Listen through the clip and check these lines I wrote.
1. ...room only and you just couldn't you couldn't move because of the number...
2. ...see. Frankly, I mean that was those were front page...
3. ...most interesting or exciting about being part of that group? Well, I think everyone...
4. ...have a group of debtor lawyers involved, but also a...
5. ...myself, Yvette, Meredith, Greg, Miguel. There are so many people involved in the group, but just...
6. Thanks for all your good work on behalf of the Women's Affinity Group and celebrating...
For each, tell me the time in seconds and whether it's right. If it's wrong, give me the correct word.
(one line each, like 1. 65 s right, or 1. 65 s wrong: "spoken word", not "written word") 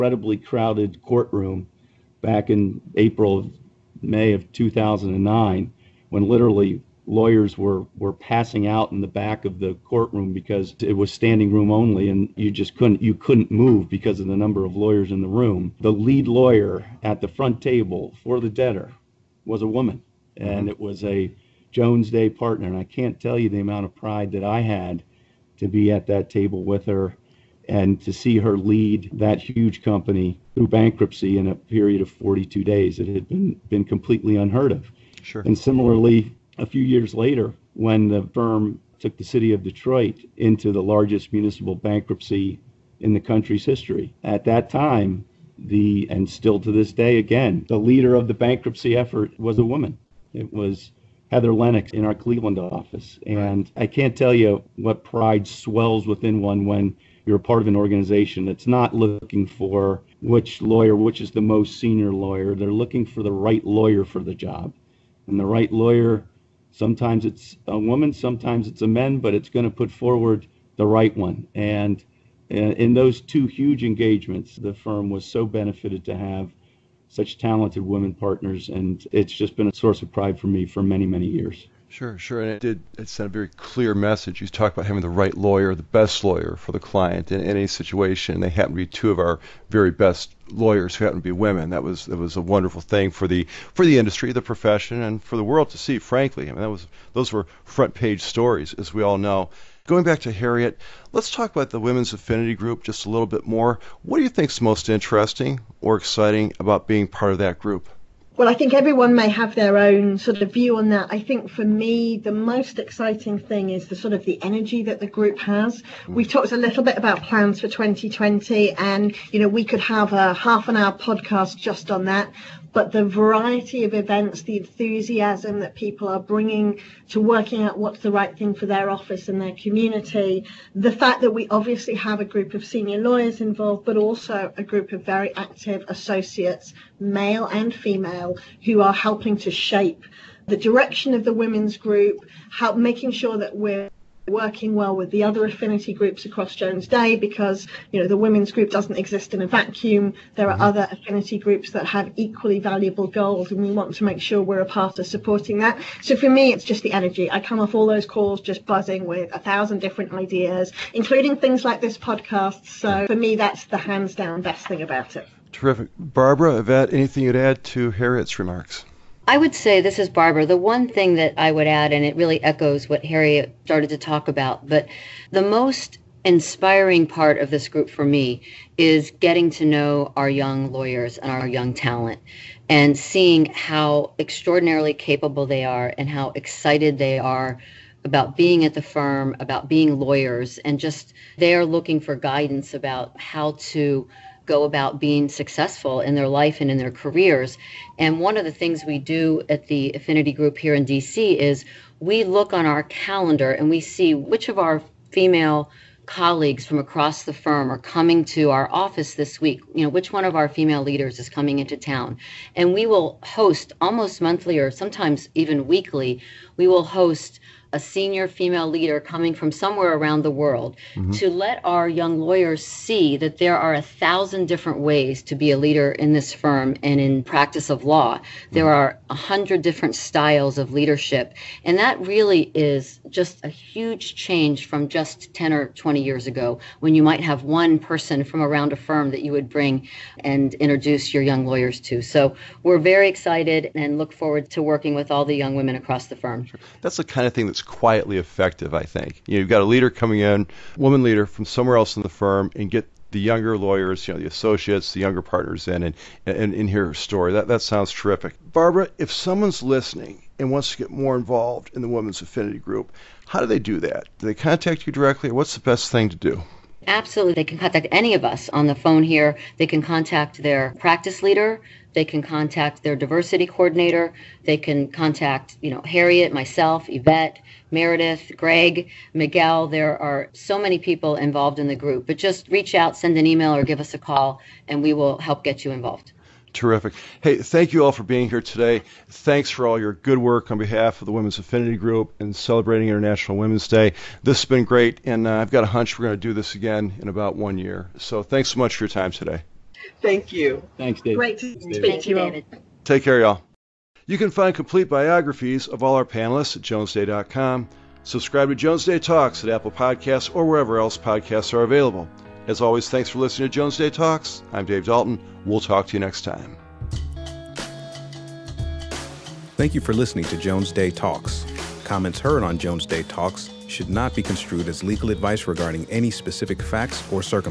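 1. 11 s right
2. 95 s right
3. 104 s right
4. 131 s wrong: "senior", not "debtor"
5. 276 s right
6. 289 s right.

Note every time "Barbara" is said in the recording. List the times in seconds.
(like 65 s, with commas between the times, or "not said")
165 s, 170 s, 258 s.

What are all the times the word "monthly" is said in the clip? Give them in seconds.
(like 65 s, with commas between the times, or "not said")
214 s.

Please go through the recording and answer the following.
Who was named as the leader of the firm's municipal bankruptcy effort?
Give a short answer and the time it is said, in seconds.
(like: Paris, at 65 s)
Heather Lennox, at 51 s.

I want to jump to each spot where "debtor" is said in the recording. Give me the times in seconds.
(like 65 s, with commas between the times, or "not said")
18 s.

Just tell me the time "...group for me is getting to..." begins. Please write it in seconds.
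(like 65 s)
177 s.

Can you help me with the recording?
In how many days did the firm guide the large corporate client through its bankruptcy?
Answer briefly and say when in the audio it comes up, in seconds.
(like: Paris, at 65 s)
42, at 32 s.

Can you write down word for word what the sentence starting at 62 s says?
They're looking for the right lawyer for the job.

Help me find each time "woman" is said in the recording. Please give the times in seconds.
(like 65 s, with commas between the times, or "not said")
19 s, 49 s, 67 s, 250 s.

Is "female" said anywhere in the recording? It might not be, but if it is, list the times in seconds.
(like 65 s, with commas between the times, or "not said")
137 s, 205 s, 210 s, 218 s.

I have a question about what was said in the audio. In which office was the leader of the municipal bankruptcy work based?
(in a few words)
Cleveland.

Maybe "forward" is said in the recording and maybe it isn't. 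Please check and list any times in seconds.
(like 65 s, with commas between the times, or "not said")
69 s, 244 s.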